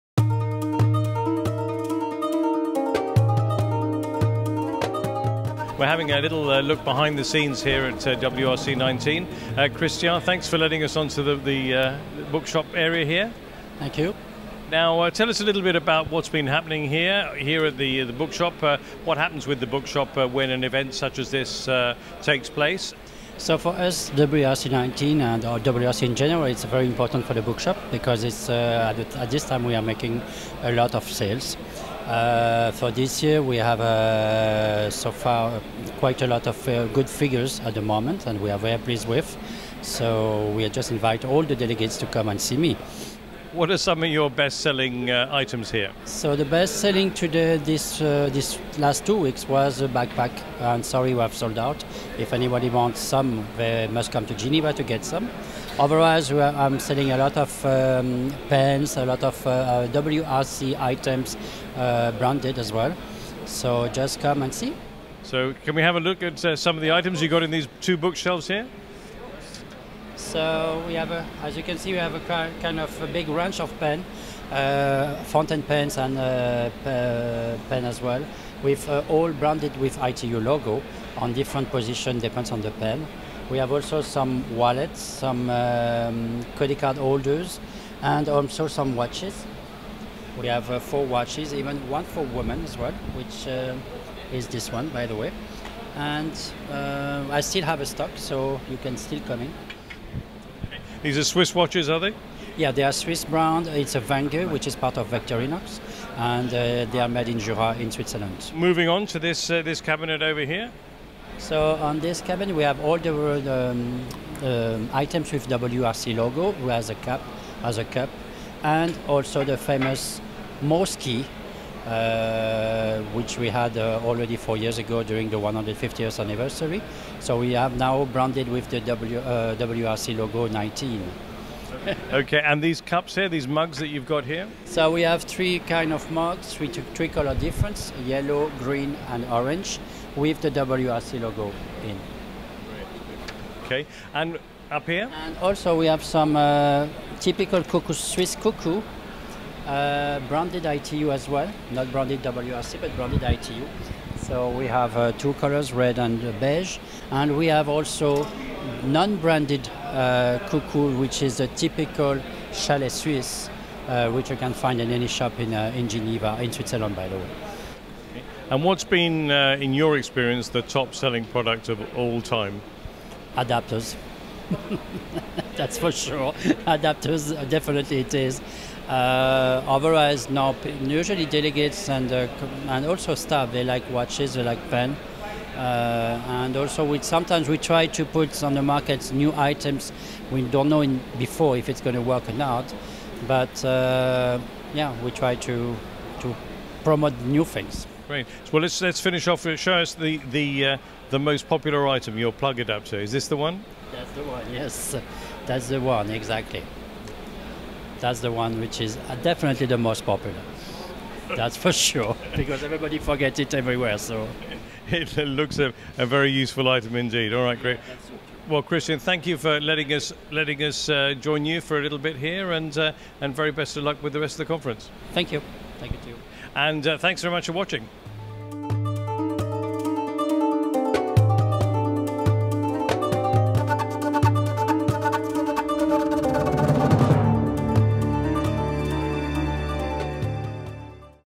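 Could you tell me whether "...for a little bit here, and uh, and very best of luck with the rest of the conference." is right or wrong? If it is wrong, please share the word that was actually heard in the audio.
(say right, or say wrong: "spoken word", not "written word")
right.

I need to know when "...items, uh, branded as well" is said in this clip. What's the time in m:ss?
1:00.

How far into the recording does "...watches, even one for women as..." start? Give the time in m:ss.
1:31.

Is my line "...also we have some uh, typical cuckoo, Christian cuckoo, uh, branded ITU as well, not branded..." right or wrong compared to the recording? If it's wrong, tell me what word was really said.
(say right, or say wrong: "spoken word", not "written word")
wrong: "Swiss", not "Christian".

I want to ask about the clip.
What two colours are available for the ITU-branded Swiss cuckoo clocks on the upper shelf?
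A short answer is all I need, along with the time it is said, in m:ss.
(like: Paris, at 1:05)
Red and beige, at 2:35.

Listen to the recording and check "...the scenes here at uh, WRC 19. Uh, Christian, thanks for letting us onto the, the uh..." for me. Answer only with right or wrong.
right.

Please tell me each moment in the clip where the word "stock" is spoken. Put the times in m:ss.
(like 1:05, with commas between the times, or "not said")
1:37.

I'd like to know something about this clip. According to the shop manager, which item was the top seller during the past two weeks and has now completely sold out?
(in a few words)
Backpack.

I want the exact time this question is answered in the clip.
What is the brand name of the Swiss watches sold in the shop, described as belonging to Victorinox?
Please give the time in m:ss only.
1:44.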